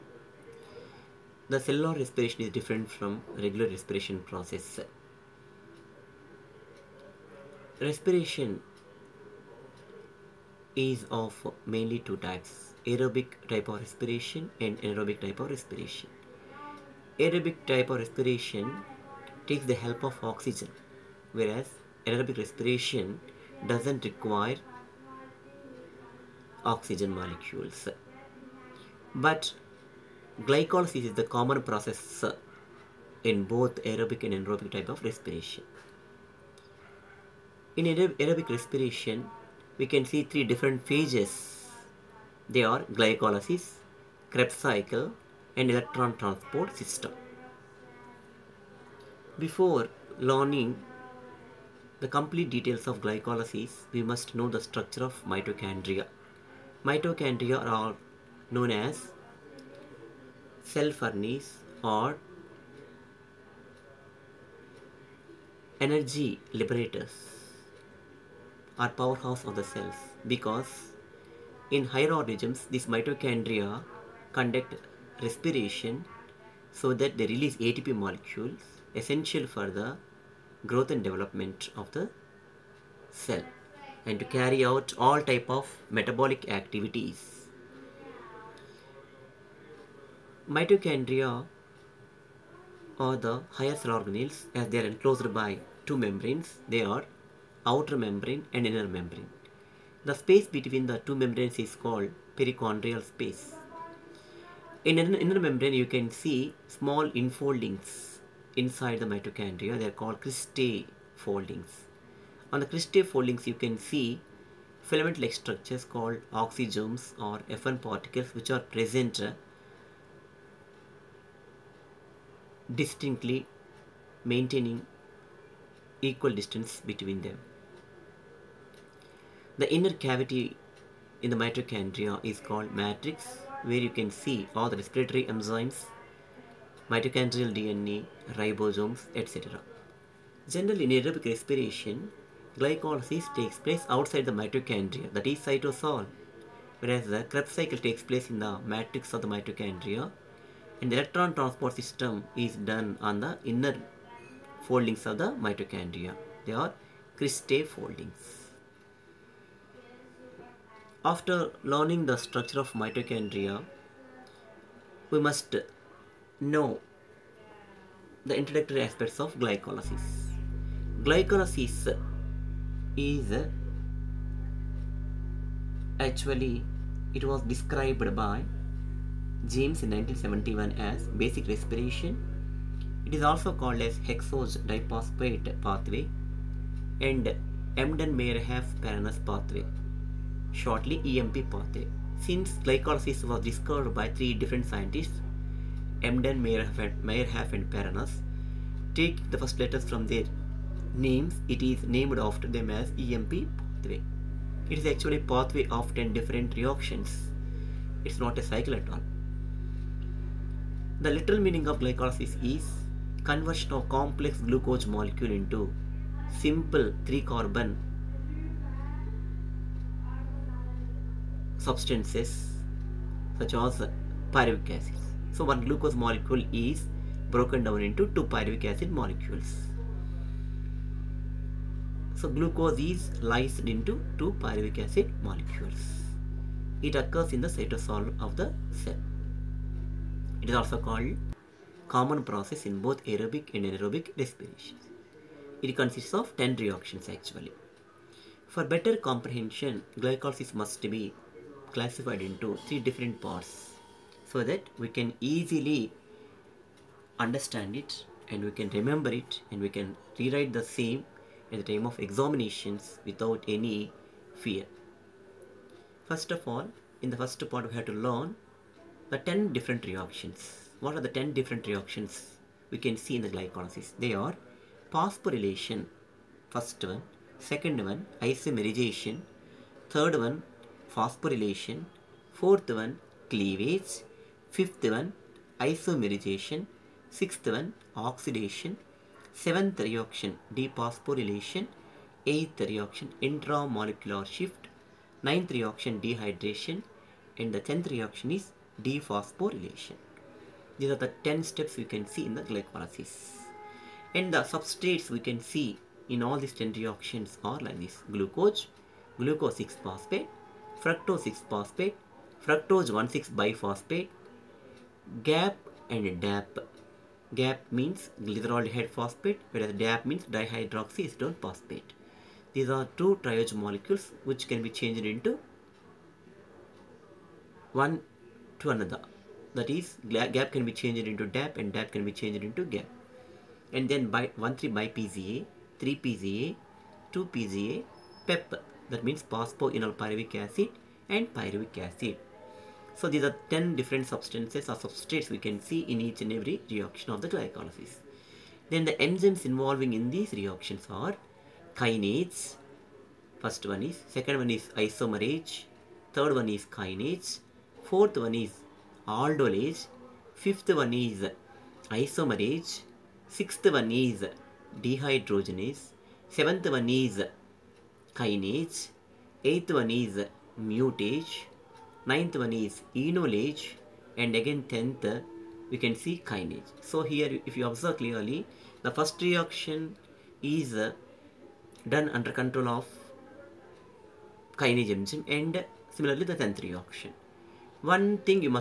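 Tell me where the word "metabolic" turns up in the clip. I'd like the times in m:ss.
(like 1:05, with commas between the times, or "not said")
1:25.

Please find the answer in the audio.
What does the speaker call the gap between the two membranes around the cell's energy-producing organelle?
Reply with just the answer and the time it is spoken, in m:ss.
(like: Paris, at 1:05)
perichondrial space, at 1:42.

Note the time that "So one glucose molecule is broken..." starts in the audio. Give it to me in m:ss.
3:45.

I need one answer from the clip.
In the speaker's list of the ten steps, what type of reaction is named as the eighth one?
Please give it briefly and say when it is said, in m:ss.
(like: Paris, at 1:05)
intramolecular shift, at 4:53.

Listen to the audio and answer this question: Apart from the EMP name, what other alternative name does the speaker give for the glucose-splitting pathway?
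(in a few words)
hexose diphosphate pathway.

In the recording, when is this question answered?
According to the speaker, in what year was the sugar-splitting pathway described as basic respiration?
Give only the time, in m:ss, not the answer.
2:59.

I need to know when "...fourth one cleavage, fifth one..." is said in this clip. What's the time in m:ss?
4:42.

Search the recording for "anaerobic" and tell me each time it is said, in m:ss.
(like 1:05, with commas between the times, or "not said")
0:14, 0:22, 0:34, 4:03.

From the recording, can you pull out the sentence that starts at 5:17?
GAP means glyceraldehyde phosphate, whereas DAP means dihydroxyacetone phosphate.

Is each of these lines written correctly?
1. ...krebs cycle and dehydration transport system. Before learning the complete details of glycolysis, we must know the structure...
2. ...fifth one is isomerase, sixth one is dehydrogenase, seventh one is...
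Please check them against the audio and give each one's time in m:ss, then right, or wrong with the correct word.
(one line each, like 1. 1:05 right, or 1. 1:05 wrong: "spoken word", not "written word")
1. 0:44 wrong: "electron", not "dehydration"
2. 6:00 right.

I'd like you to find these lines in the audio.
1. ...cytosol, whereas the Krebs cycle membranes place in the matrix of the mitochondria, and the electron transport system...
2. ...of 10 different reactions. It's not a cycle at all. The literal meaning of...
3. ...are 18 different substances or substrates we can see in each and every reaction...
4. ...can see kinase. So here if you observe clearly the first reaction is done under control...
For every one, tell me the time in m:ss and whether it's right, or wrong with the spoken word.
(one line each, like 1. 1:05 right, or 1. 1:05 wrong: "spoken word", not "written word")
1. 2:25 wrong: "takes", not "membranes"
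2. 3:25 right
3. 5:43 wrong: "10", not "18"
4. 6:15 right.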